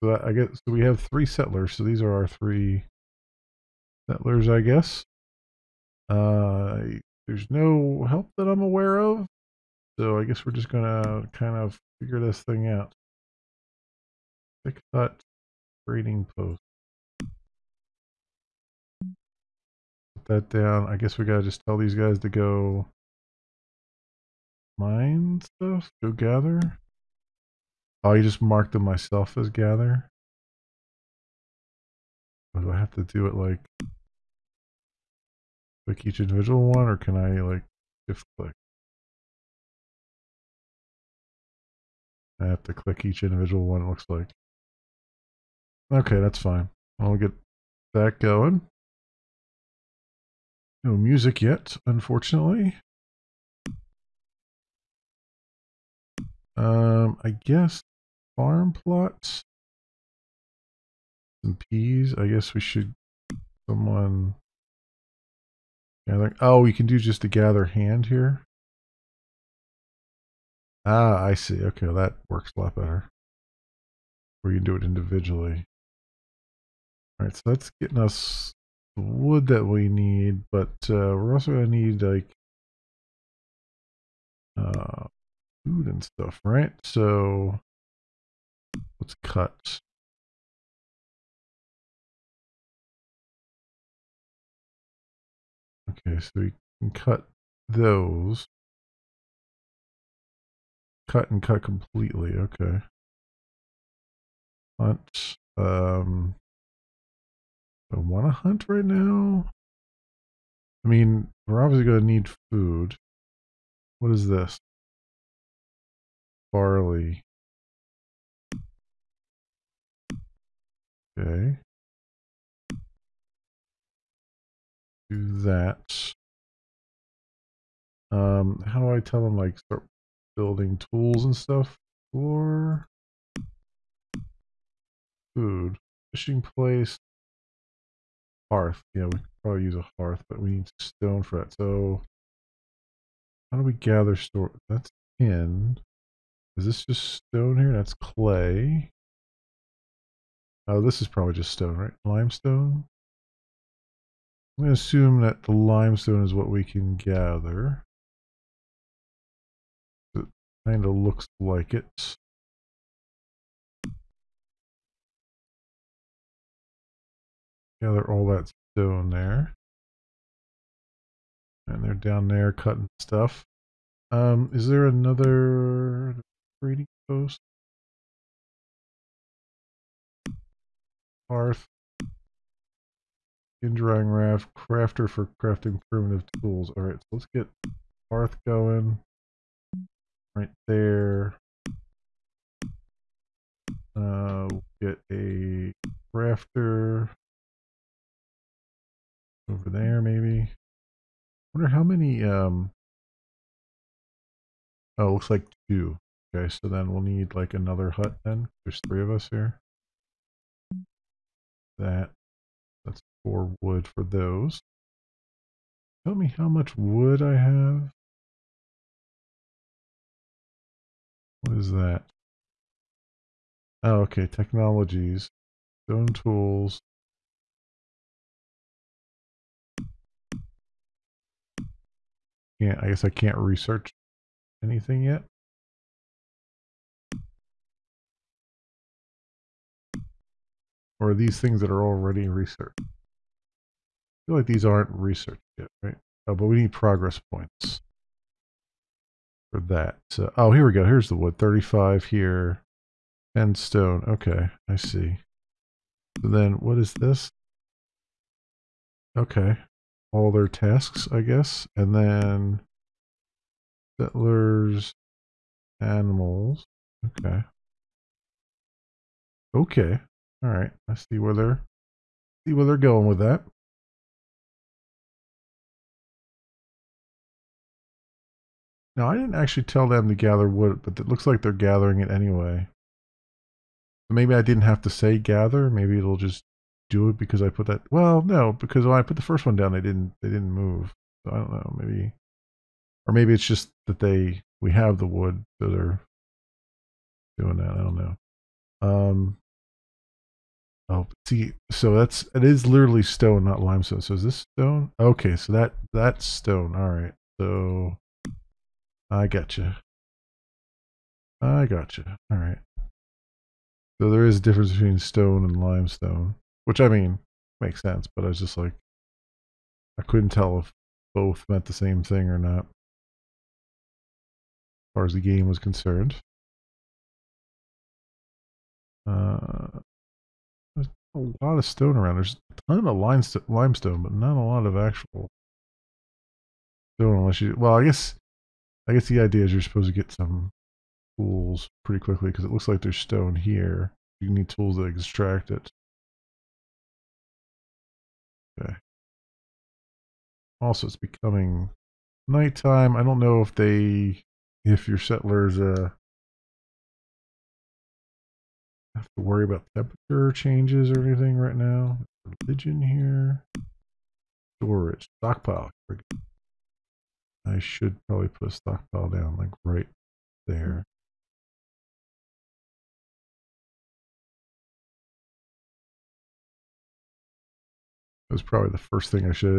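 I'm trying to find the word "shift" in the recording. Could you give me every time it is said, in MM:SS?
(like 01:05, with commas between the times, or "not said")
00:38.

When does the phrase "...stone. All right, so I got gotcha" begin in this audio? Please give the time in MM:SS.
05:06.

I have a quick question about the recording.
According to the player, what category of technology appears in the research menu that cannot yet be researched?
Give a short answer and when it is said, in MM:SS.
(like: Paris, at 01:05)
Stone tools, at 03:45.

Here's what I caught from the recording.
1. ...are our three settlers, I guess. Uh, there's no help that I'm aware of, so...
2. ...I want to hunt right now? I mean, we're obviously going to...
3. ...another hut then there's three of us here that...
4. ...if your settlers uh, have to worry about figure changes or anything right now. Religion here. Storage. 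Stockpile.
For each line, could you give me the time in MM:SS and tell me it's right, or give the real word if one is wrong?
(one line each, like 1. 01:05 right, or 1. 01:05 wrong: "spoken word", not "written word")
1. 00:02 right
2. 01:47 right
3. 03:27 right
4. 05:54 wrong: "temperature", not "figure".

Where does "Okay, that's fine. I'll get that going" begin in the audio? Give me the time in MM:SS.
00:45.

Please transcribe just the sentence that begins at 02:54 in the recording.
Um, is there another reading post?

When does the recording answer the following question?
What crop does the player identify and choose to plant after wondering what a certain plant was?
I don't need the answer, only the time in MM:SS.
01:56.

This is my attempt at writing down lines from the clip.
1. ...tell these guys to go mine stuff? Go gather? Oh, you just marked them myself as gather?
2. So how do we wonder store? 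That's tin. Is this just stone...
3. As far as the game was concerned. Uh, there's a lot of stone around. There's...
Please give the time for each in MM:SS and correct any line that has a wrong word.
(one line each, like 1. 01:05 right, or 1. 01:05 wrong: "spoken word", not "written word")
1. 00:21 right
2. 02:21 wrong: "gather", not "wonder"
3. 05:24 right.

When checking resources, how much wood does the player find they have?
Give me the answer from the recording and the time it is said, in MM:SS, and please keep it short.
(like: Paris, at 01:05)
35, at 04:11.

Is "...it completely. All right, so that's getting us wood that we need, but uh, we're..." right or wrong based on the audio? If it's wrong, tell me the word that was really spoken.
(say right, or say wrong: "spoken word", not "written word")
wrong: "individually", not "completely".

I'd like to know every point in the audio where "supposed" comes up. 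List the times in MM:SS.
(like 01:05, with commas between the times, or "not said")
05:39.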